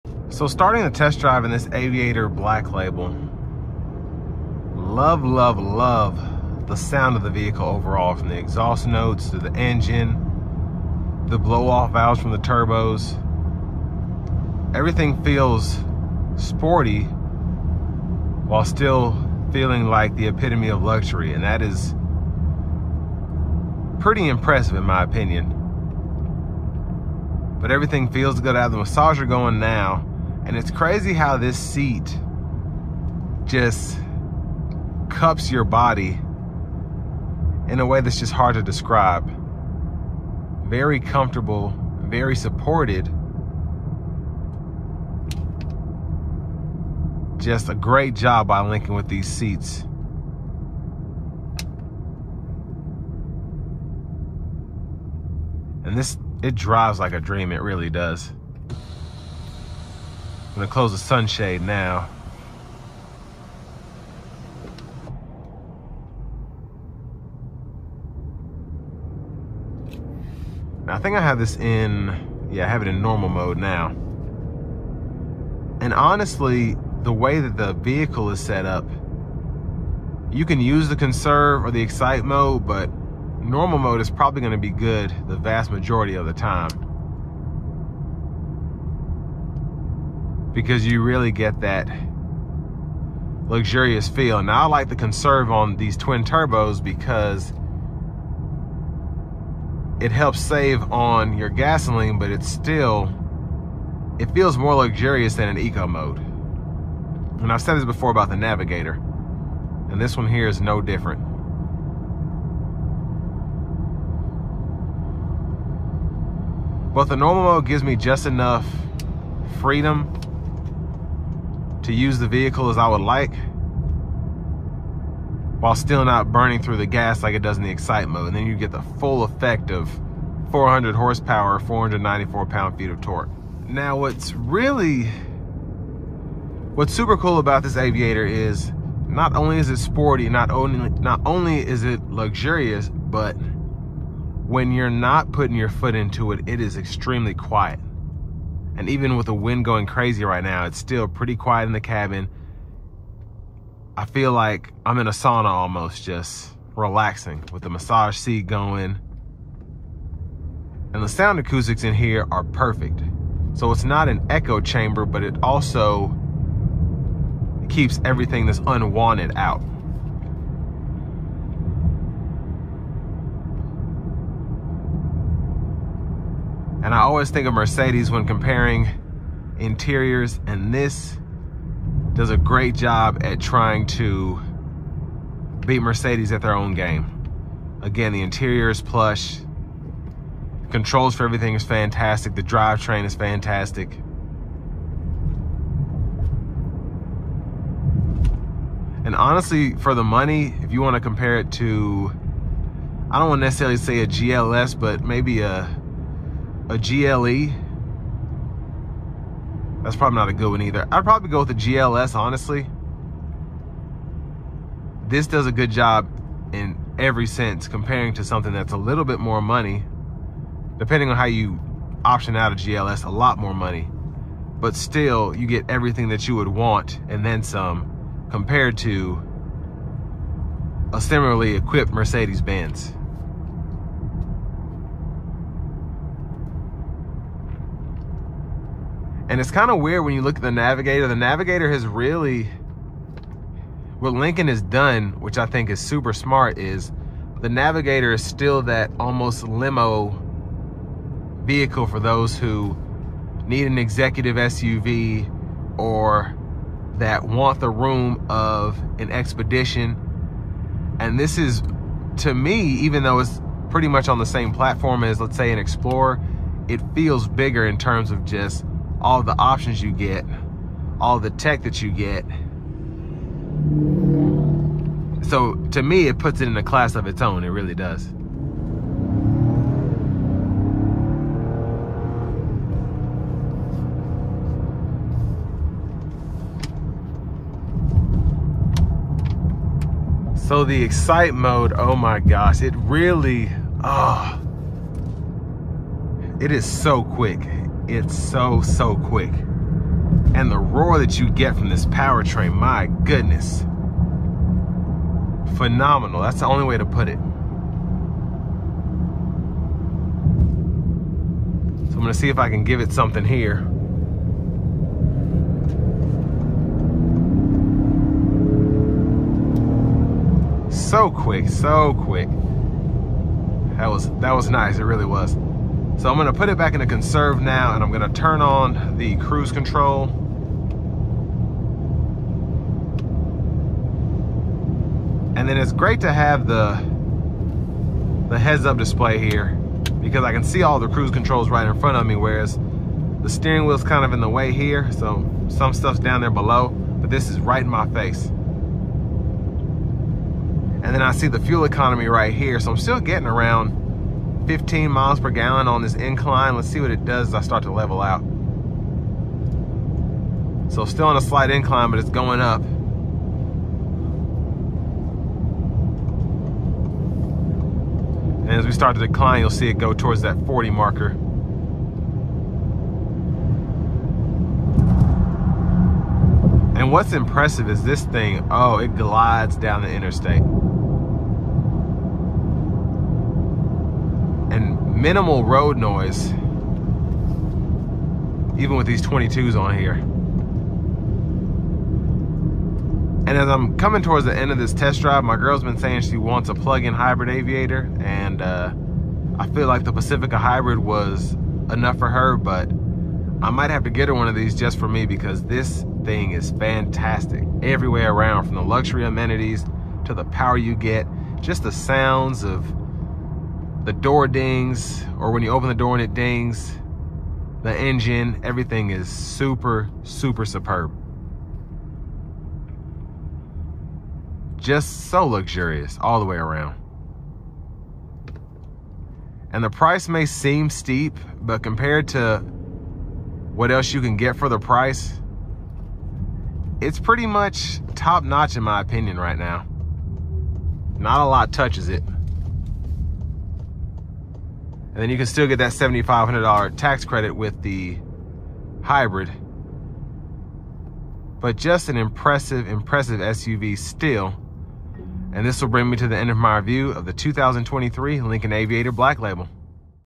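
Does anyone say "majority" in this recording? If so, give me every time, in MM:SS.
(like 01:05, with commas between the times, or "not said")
01:25.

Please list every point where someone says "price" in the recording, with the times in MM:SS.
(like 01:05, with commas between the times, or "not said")
07:09, 07:14.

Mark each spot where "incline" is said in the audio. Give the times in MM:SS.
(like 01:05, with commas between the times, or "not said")
05:55, 06:01.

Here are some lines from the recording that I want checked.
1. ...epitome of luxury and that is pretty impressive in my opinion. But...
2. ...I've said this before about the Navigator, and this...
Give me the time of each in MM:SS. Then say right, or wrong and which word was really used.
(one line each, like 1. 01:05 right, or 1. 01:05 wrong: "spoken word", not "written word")
1. 00:20 right
2. 01:47 right.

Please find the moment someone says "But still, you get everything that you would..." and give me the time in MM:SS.
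03:44.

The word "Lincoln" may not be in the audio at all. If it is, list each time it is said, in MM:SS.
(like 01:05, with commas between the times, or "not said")
00:48, 04:04, 07:38.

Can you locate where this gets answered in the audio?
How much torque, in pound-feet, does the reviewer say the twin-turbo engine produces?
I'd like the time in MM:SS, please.
02:11.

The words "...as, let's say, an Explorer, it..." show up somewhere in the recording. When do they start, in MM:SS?
04:25.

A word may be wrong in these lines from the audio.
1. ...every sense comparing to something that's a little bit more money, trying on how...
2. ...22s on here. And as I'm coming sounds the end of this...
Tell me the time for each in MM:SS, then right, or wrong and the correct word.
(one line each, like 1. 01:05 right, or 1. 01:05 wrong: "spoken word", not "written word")
1. 03:36 wrong: "depending", not "trying"
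2. 06:29 wrong: "towards", not "sounds".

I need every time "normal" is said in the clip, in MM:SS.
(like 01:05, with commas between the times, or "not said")
01:13, 01:23, 01:57.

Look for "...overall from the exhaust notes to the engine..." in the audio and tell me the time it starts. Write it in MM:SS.
00:07.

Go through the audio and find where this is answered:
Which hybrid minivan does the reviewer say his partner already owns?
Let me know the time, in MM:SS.
06:39.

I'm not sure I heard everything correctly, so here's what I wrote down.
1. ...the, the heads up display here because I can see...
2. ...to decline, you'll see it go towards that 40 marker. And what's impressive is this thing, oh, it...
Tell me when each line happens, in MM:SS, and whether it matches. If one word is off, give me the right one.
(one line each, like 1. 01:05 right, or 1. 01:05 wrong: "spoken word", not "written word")
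1. 05:36 right
2. 06:08 right.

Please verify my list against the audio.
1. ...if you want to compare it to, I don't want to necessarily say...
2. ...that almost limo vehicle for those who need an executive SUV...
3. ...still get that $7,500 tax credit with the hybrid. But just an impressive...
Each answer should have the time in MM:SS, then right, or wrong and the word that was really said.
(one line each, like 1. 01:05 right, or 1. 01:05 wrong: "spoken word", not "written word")
1. 03:20 right
2. 04:08 right
3. 07:25 right.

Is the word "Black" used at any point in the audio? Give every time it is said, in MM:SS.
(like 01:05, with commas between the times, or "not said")
00:02, 07:38.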